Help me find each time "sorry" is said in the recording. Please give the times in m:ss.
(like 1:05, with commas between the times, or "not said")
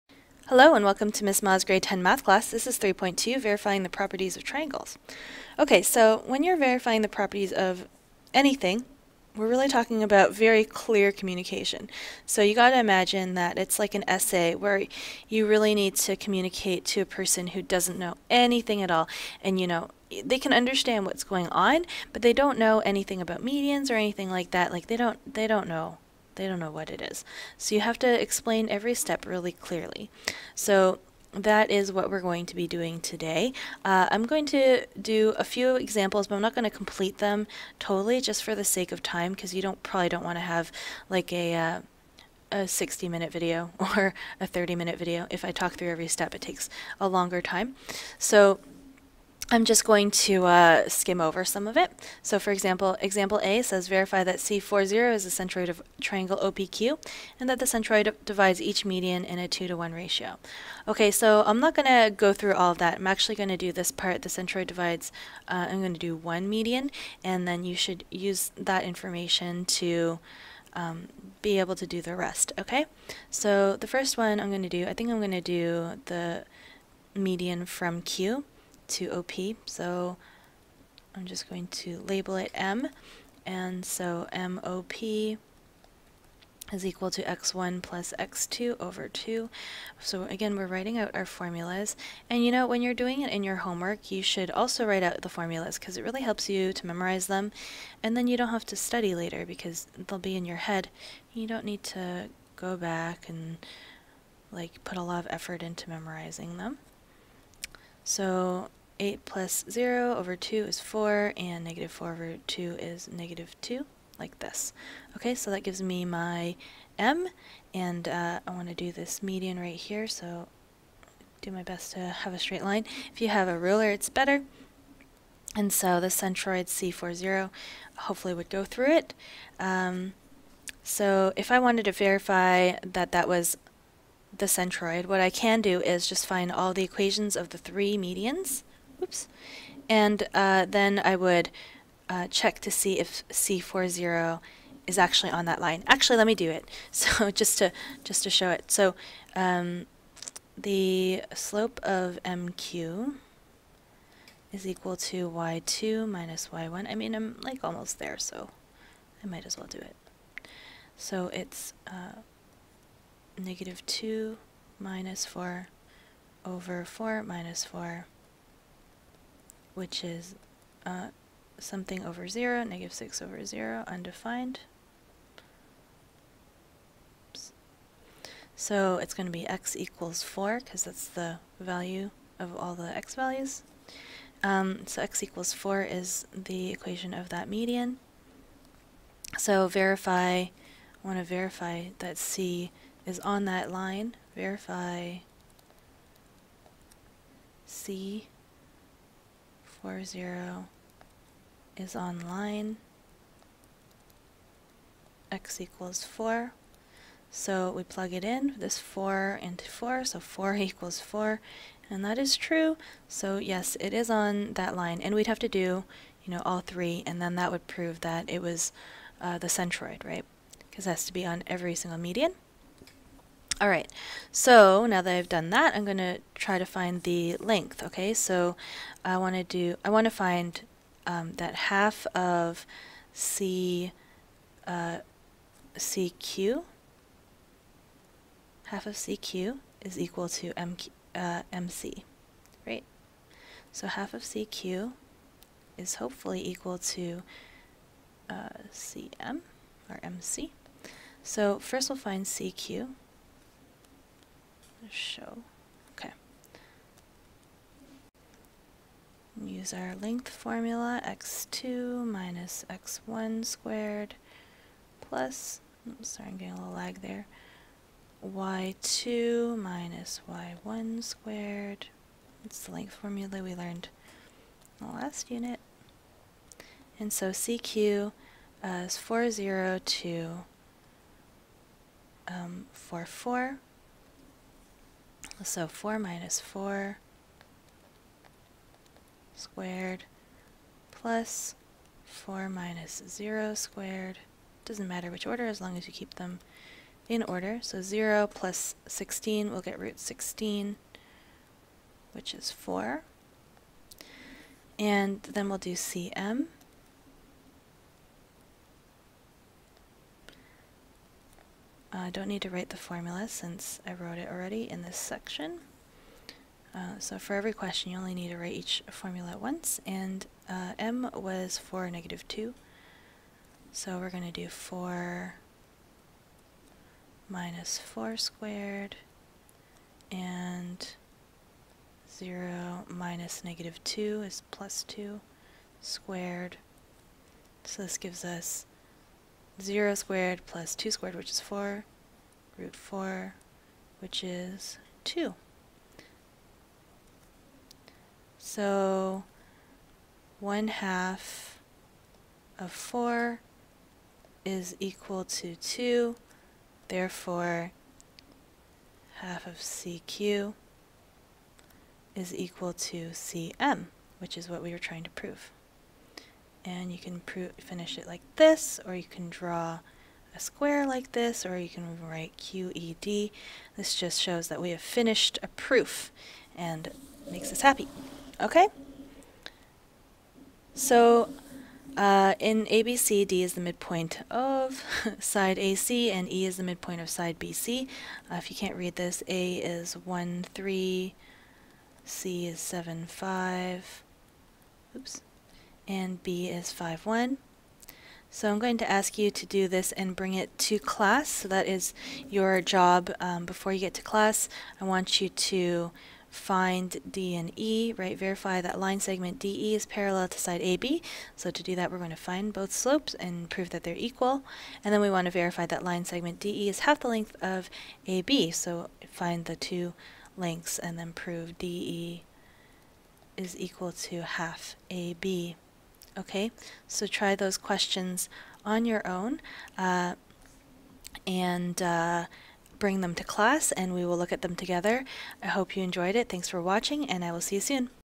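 4:26.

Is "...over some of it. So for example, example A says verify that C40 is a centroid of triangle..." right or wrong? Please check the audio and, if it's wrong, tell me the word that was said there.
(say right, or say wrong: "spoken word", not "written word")
right.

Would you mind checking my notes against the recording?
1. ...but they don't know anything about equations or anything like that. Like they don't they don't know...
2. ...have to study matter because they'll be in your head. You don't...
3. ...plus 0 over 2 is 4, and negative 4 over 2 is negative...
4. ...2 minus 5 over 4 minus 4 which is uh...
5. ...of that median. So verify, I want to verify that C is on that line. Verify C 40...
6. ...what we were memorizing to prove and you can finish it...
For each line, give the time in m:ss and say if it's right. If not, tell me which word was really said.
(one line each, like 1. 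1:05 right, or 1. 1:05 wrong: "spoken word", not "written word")
1. 0:22 wrong: "medians", not "equations"
2. 1:38 wrong: "later", not "matter"
3. 1:49 right
4. 2:43 wrong: "4", not "5"
5. 3:07 right
6. 6:04 wrong: "trying", not "memorizing".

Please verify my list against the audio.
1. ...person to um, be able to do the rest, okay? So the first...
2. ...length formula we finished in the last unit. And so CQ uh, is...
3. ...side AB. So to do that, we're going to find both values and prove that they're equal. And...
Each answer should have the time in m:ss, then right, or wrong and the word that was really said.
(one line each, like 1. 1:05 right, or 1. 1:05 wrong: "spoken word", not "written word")
1. 1:08 wrong: "information", not "person"
2. 4:32 wrong: "learned", not "finished"
3. 6:50 wrong: "slopes", not "values".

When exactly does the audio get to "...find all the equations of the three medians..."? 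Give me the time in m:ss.
2:16.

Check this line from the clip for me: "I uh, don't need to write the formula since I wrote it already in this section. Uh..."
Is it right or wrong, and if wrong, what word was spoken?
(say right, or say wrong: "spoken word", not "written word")
right.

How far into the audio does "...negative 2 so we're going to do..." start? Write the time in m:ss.
5:21.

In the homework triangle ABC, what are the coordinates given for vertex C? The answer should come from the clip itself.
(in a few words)
(7, 5).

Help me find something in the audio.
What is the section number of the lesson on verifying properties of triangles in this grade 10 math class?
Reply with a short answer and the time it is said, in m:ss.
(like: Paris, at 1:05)
3.2, at 0:02.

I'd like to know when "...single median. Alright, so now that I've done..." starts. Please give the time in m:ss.
3:41.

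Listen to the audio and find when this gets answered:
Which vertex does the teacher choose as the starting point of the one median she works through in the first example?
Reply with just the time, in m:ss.
1:18.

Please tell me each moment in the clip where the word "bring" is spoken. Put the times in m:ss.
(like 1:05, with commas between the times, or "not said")
6:40, 7:12.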